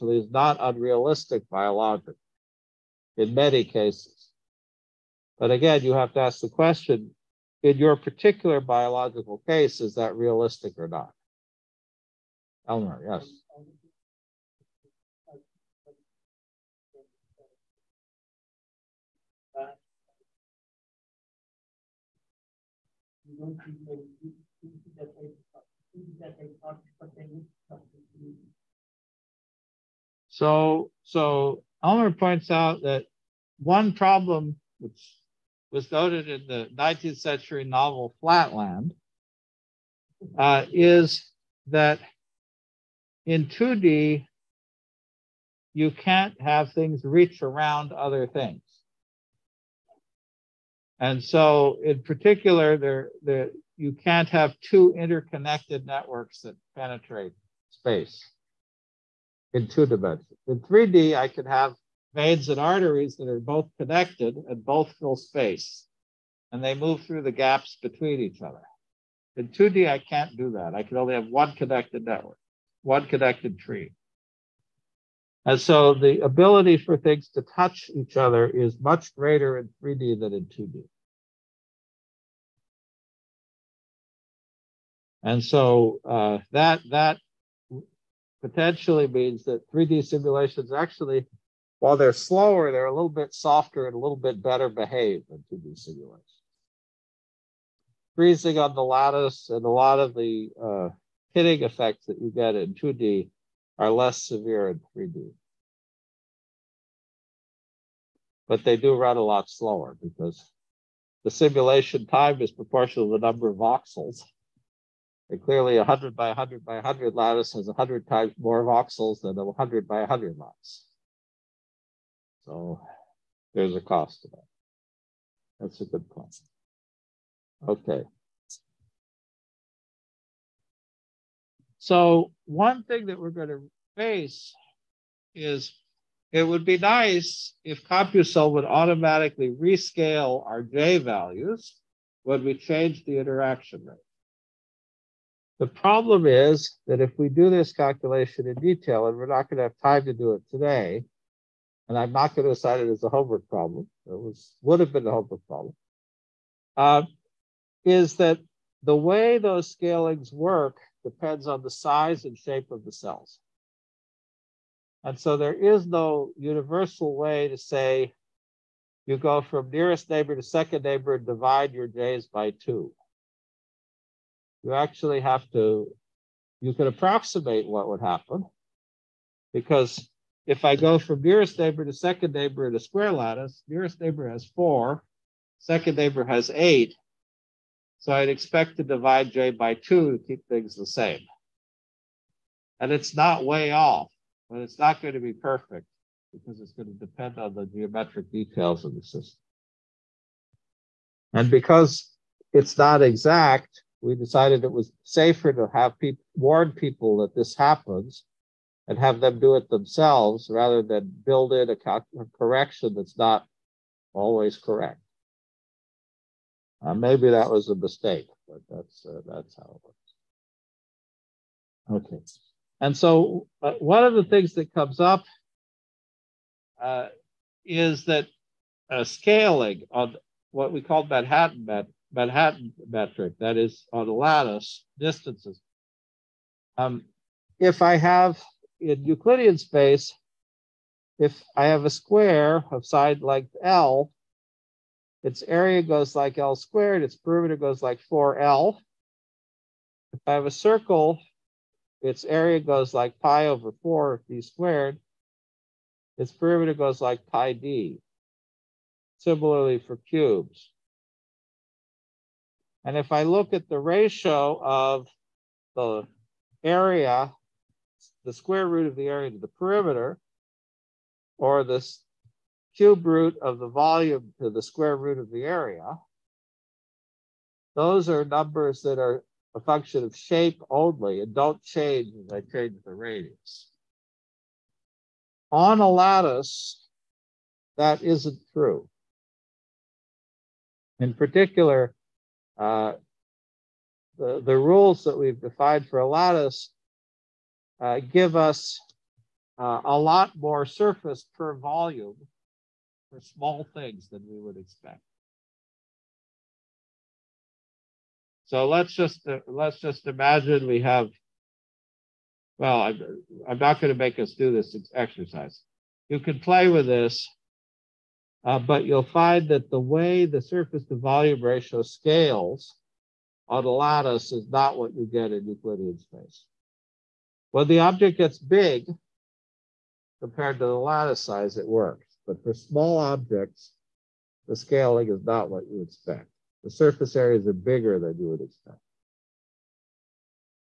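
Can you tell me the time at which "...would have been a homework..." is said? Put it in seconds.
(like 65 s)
154 s.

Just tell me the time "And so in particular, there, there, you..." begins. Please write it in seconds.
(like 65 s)
51 s.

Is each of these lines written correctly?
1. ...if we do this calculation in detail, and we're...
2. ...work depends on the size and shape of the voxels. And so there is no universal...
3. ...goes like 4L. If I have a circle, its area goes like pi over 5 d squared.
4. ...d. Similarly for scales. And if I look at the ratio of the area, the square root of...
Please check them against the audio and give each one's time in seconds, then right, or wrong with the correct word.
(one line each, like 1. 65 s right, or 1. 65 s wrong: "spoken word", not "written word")
1. 147 s right
2. 160 s wrong: "cells", not "voxels"
3. 247 s wrong: "4", not "5"
4. 257 s wrong: "cubes", not "scales".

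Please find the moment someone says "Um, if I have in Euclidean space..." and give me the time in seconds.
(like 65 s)
236 s.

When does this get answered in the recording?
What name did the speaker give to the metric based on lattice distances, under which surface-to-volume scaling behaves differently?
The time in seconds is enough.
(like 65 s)
231 s.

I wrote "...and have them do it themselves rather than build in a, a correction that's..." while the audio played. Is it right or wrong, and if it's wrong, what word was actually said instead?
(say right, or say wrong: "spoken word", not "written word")
right.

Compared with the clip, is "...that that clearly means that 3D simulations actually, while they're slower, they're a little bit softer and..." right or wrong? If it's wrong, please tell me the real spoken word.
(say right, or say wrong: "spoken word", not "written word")
wrong: "potentially", not "clearly".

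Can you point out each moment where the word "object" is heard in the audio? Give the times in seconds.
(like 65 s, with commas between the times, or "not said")
327 s, 332 s.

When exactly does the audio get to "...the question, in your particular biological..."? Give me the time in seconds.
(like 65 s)
6 s.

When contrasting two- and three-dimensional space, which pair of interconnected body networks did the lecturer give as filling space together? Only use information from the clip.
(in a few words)
veins and arteries.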